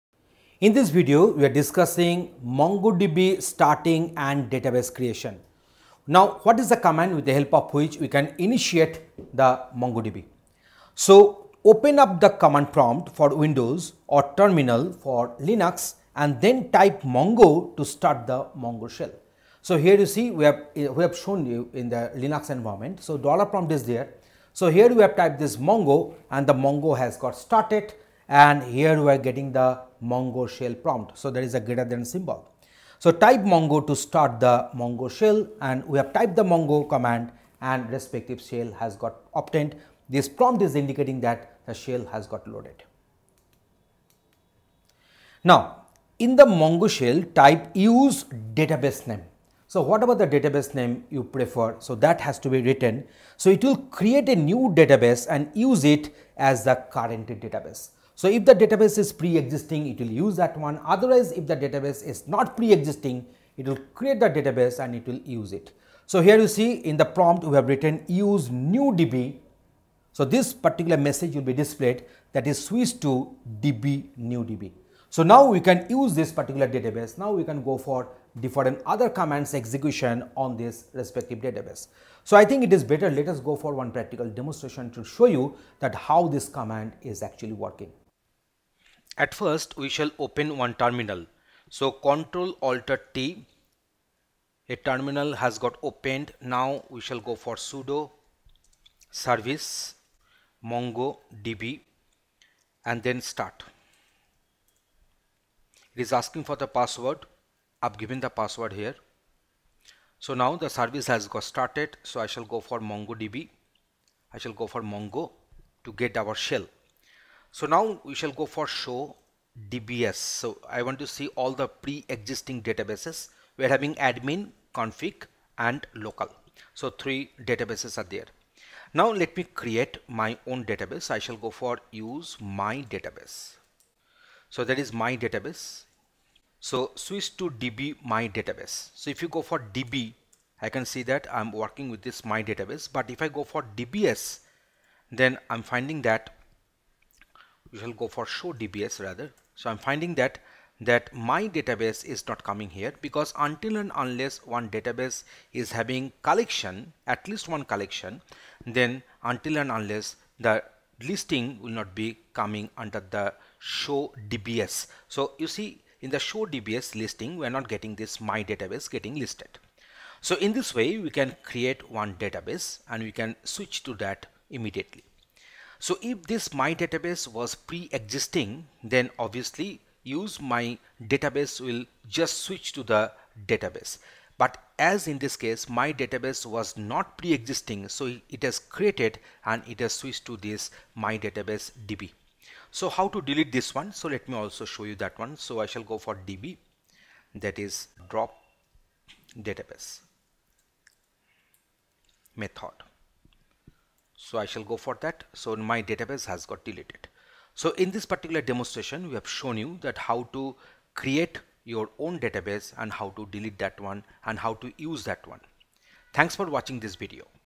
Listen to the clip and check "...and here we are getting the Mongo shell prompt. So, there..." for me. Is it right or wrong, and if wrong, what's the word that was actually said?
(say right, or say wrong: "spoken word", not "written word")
right.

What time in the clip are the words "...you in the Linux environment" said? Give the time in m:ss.
0:21.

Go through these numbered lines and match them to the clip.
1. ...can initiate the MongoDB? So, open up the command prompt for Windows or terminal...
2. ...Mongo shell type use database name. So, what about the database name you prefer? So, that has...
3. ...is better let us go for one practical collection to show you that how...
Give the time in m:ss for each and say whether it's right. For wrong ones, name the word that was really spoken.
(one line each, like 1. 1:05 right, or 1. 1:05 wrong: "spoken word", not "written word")
1. 0:08 right
2. 0:46 right
3. 1:22 wrong: "demonstration", not "collection".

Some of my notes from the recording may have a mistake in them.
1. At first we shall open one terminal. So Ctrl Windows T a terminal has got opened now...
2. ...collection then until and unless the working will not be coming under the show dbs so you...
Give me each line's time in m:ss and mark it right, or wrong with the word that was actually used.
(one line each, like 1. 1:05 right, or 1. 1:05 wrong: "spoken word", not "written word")
1. 1:29 wrong: "Alt", not "Windows"
2. 2:37 wrong: "listing", not "working".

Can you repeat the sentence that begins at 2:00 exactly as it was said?
So I want to see all the pre-existing databases.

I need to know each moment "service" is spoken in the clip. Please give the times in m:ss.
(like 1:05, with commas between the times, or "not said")
1:39, 1:50.